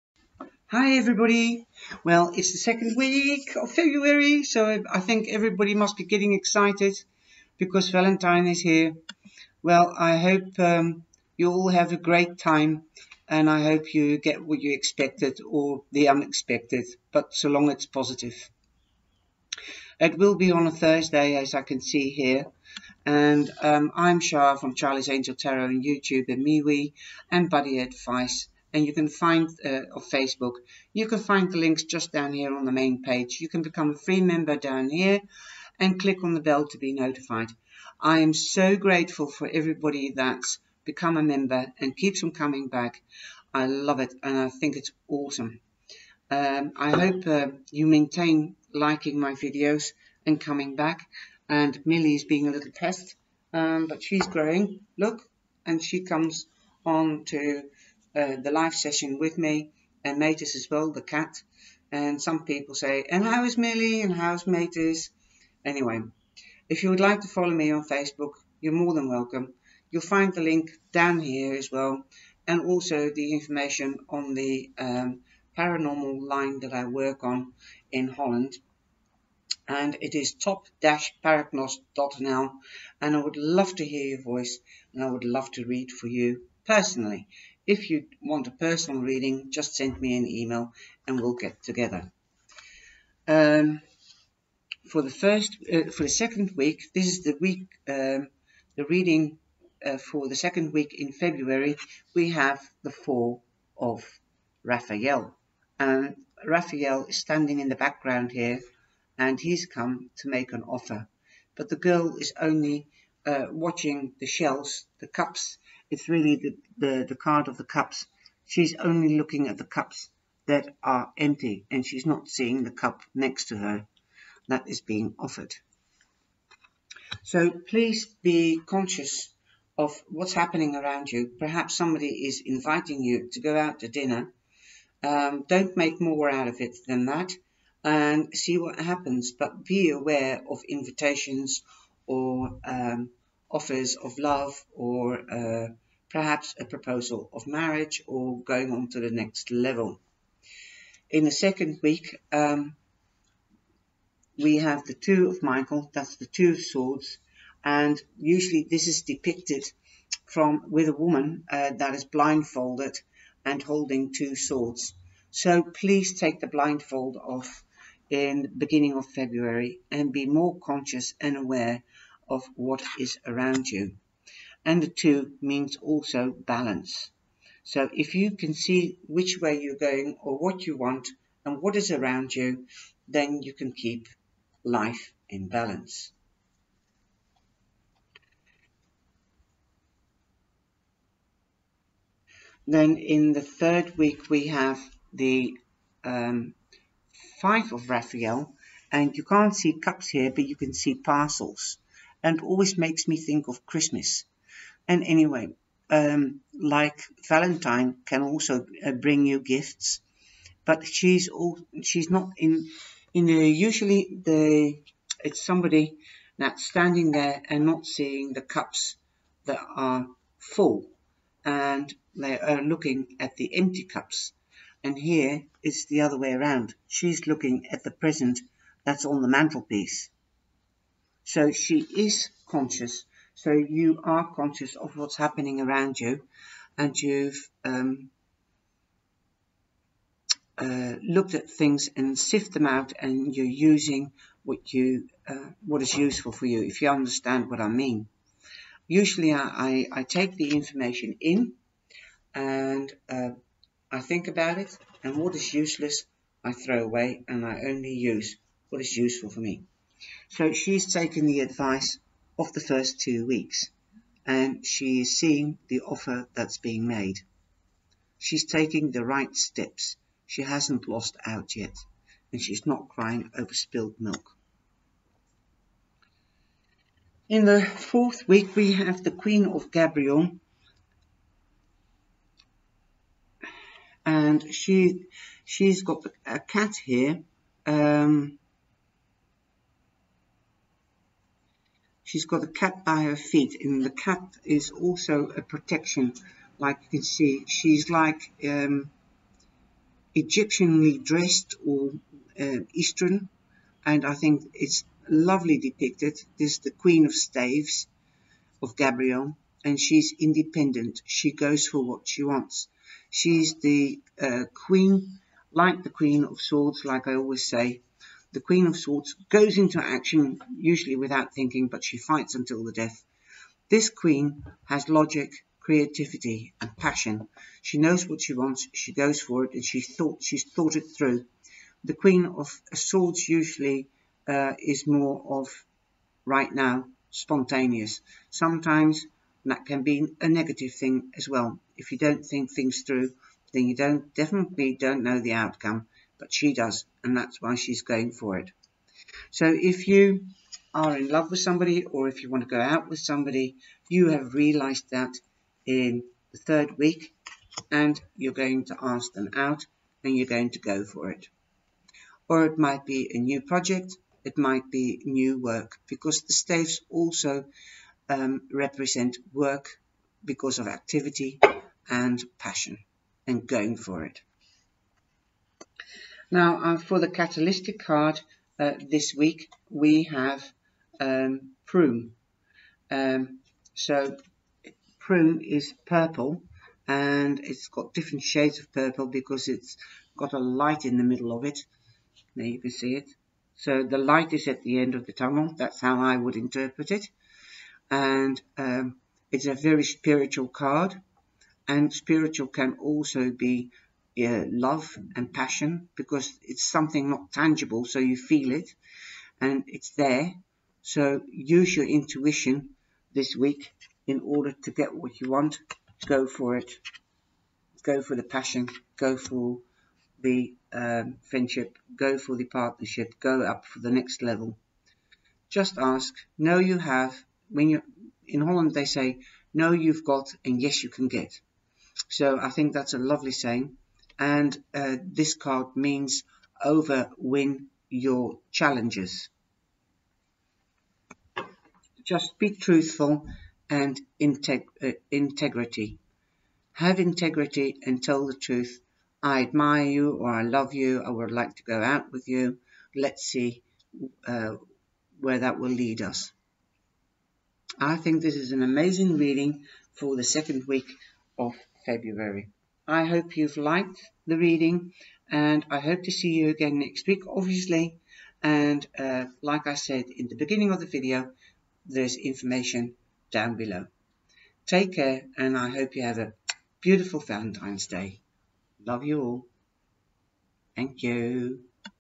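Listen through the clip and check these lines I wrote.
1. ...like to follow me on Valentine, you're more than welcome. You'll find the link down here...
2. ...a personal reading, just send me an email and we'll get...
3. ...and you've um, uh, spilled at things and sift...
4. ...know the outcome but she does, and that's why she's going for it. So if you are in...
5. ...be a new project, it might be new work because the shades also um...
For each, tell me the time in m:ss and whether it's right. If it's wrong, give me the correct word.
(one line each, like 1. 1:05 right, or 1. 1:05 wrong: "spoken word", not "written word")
1. 1:07 wrong: "Facebook", not "Valentine"
2. 1:28 right
3. 3:56 wrong: "looked", not "spilled"
4. 5:45 right
5. 6:02 wrong: "staves", not "shades".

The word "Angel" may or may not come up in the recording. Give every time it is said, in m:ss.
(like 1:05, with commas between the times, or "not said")
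0:25.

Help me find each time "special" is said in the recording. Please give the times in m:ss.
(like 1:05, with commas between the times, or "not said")
not said.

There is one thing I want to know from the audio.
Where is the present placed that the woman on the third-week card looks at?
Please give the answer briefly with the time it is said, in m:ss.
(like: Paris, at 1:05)
Mantelpiece, at 3:49.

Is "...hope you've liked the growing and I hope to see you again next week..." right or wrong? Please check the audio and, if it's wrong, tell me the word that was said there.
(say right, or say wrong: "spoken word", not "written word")
wrong: "reading", not "growing".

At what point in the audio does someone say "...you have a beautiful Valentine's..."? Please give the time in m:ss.
7:55.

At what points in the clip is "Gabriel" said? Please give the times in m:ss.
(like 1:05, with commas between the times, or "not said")
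4:39, 5:08.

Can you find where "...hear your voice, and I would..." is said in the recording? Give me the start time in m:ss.
1:23.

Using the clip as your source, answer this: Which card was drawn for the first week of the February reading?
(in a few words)
Four of Raphael.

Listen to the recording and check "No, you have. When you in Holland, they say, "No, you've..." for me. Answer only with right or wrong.
right.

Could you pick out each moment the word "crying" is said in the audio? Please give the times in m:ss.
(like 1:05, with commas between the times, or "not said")
4:32.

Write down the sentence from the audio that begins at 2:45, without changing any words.
So please take the blindfold off in the beginning of February and be more conscious and aware of what is around you.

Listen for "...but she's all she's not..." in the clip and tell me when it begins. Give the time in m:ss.
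3:30.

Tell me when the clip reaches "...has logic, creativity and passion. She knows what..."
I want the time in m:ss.
5:24.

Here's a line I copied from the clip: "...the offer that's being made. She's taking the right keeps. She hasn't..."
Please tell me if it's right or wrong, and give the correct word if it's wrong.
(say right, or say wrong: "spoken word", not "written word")
wrong: "steps", not "keeps".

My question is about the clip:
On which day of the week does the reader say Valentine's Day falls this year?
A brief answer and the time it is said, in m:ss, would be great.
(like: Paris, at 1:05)
Thursday, at 0:20.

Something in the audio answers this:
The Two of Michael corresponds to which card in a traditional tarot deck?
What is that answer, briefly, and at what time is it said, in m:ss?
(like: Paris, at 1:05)
Two of Swords, at 2:36.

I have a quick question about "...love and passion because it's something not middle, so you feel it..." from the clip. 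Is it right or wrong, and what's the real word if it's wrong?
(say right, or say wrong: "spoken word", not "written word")
wrong: "tangible", not "middle".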